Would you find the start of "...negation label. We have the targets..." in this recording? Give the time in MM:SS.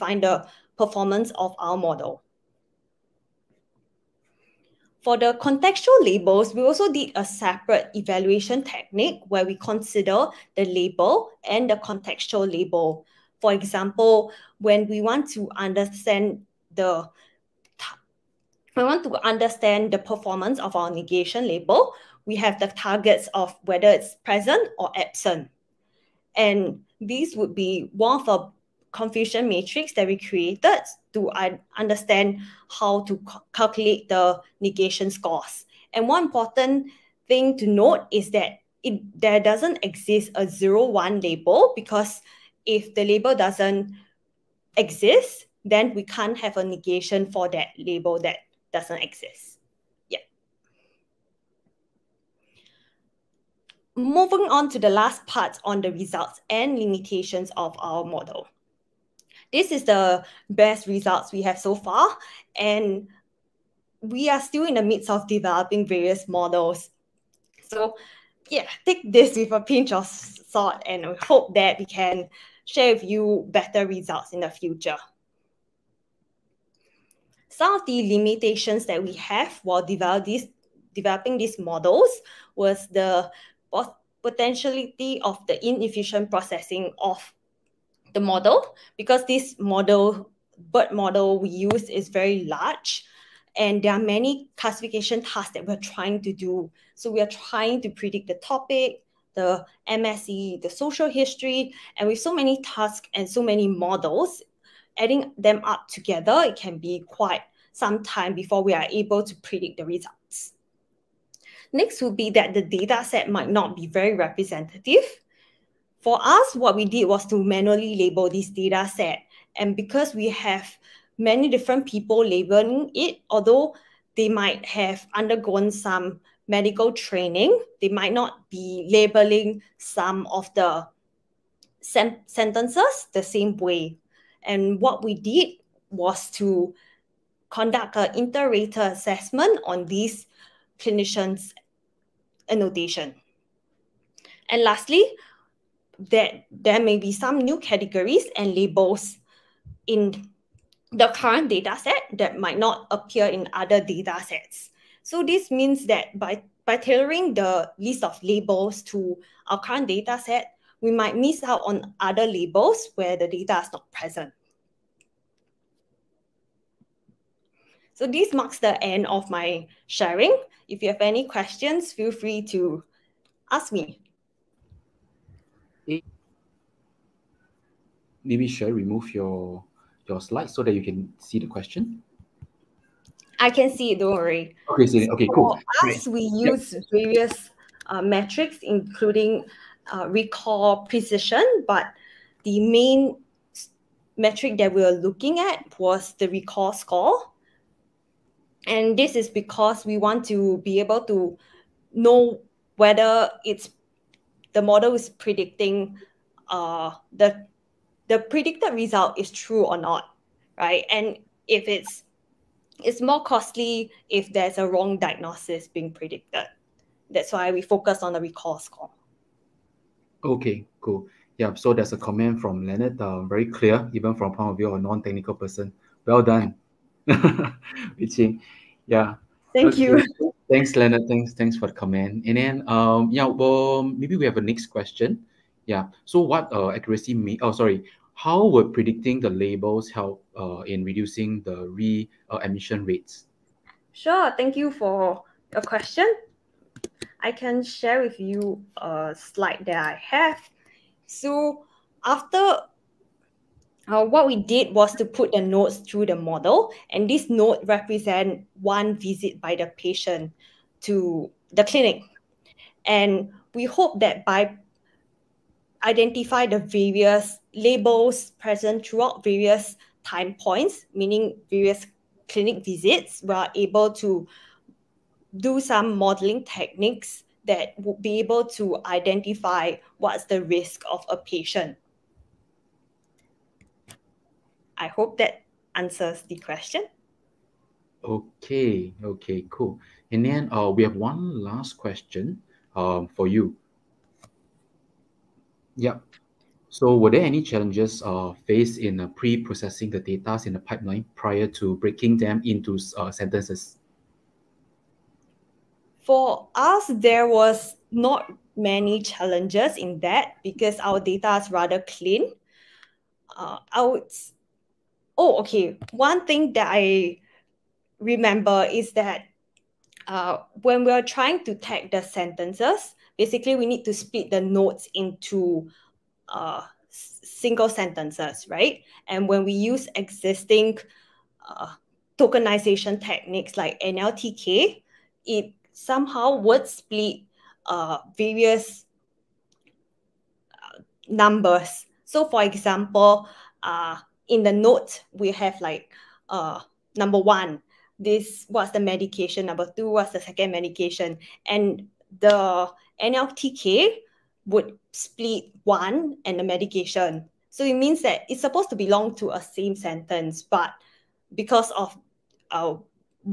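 00:20.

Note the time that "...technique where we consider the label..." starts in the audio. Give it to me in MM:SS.
00:08.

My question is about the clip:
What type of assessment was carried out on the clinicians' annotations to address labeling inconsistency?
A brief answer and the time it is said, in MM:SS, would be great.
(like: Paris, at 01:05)
Inter-rater assessment, at 02:18.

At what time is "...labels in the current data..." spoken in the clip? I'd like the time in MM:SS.
02:28.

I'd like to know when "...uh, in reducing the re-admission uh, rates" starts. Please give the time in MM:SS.
04:00.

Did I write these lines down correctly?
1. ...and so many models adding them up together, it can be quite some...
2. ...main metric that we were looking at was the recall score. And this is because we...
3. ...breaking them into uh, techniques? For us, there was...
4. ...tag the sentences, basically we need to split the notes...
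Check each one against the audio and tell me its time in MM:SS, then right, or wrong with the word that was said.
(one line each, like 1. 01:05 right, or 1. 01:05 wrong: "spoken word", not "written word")
1. 01:43 right
2. 03:12 right
3. 05:01 wrong: "sentences", not "techniques"
4. 05:21 right.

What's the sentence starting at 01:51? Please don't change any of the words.
Next would be that the data set might not be very representative.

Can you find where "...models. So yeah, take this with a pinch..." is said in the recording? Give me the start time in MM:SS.
01:06.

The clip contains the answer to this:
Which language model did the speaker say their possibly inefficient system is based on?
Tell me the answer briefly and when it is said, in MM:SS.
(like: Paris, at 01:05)
BERT, at 01:30.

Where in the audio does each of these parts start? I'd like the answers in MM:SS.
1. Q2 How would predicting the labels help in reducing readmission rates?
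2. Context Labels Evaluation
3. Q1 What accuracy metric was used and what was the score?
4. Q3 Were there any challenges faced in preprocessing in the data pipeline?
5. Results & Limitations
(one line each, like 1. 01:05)
1. 03:57
2. 00:05
3. 02:57
4. 04:54
5. 00:52.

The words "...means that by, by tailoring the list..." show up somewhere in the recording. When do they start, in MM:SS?
02:35.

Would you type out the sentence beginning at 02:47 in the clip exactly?
So this marks the end of my sharing.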